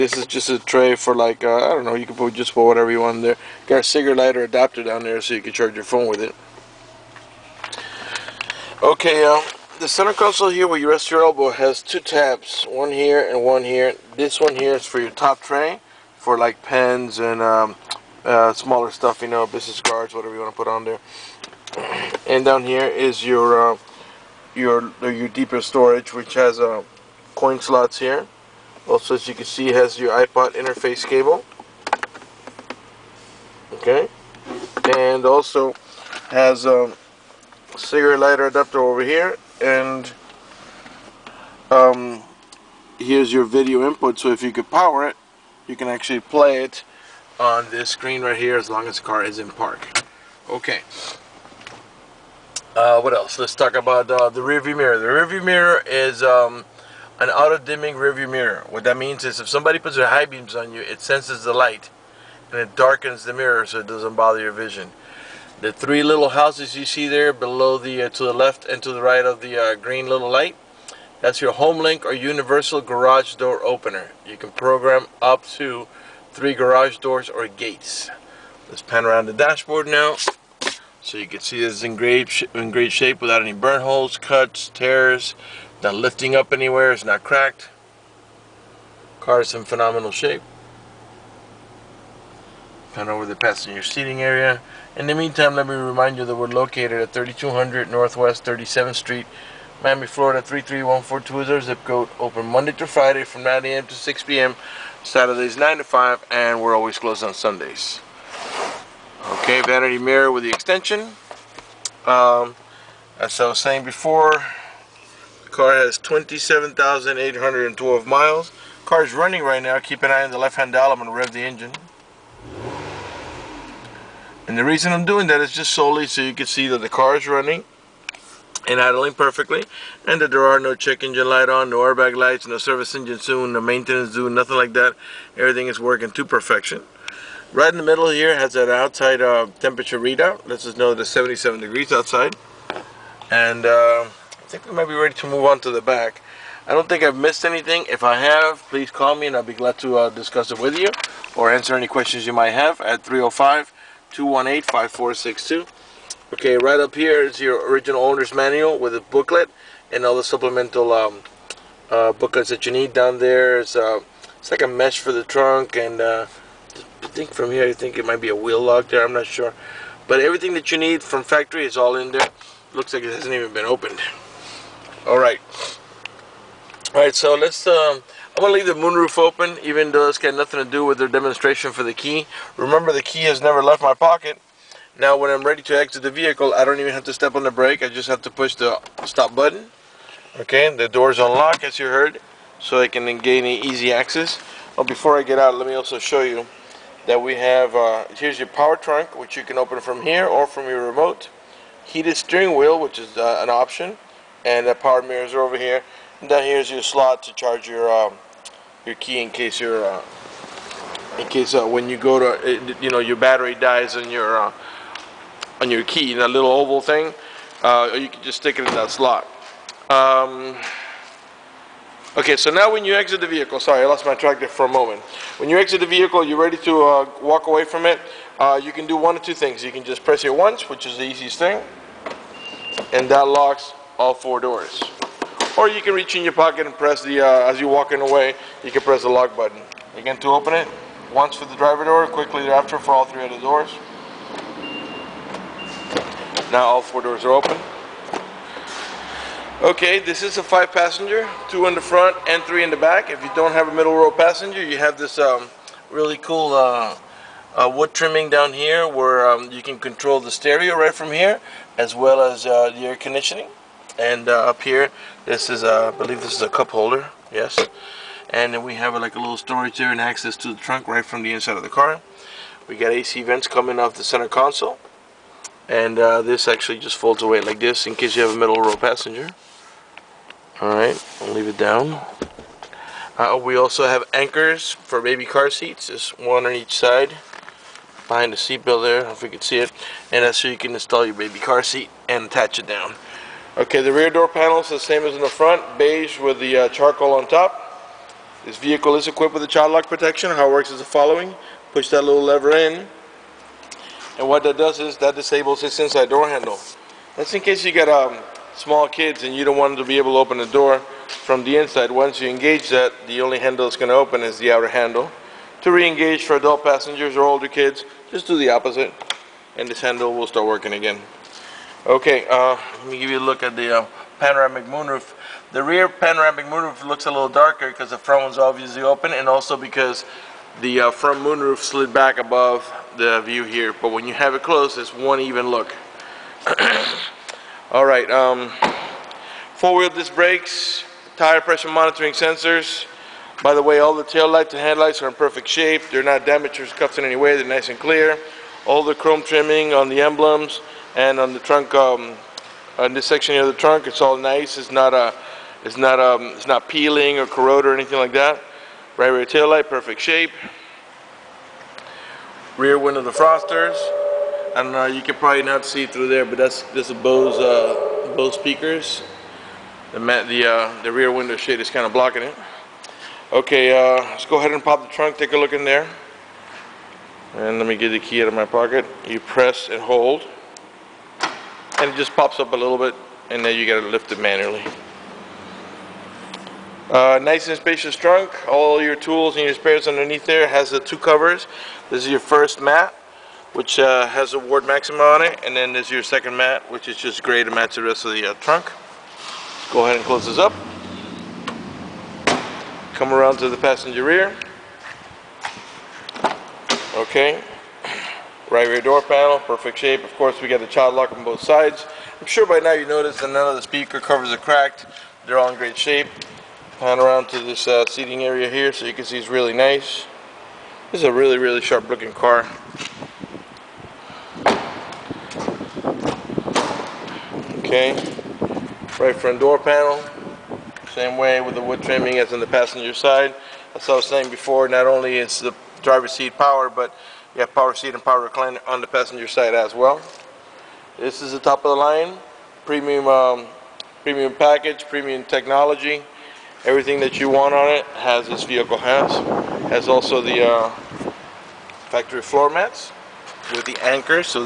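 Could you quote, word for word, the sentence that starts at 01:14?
You can program up to three garage doors or gates.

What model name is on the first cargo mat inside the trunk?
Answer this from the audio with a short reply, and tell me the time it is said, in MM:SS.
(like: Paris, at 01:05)
Maxima, at 06:34.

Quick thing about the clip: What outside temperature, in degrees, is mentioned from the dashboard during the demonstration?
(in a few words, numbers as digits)
77.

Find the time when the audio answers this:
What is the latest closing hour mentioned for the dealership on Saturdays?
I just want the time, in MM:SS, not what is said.
01:45.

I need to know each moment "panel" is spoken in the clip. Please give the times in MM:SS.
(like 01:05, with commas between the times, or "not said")
04:54, 06:49, 07:09.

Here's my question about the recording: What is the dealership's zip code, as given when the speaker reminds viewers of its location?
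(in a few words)
33142.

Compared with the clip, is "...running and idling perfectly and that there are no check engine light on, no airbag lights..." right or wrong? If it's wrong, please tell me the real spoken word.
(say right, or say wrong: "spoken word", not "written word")
right.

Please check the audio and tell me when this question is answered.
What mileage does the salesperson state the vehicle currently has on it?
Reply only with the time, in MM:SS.
01:55.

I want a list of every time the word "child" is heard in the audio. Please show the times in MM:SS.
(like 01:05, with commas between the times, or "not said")
04:59, 06:50.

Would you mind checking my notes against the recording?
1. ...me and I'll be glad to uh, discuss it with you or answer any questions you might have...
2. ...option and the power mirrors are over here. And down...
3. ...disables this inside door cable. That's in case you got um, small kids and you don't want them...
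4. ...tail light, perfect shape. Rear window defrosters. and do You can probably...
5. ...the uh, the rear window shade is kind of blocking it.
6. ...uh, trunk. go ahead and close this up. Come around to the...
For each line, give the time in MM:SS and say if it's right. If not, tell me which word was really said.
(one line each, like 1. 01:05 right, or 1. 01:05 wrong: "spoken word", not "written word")
1. 02:29 right
2. 03:23 right
3. 05:05 wrong: "handle", not "cable"
4. 05:59 right
5. 06:10 right
6. 06:38 right.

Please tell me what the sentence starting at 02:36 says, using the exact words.
Okay, right up here is your original owner's manual with a booklet and all the supplemental um, uh, booklets that you need.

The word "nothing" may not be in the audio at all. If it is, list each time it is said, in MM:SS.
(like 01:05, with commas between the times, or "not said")
02:14, 03:00.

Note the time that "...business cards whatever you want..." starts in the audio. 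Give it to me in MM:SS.
00:19.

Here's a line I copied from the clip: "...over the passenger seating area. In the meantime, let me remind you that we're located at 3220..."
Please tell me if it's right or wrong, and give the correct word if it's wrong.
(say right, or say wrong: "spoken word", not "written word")
wrong: "3200", not "3220".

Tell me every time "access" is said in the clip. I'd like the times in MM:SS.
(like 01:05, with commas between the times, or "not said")
03:13, 04:30.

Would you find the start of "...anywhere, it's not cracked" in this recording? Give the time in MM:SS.
01:26.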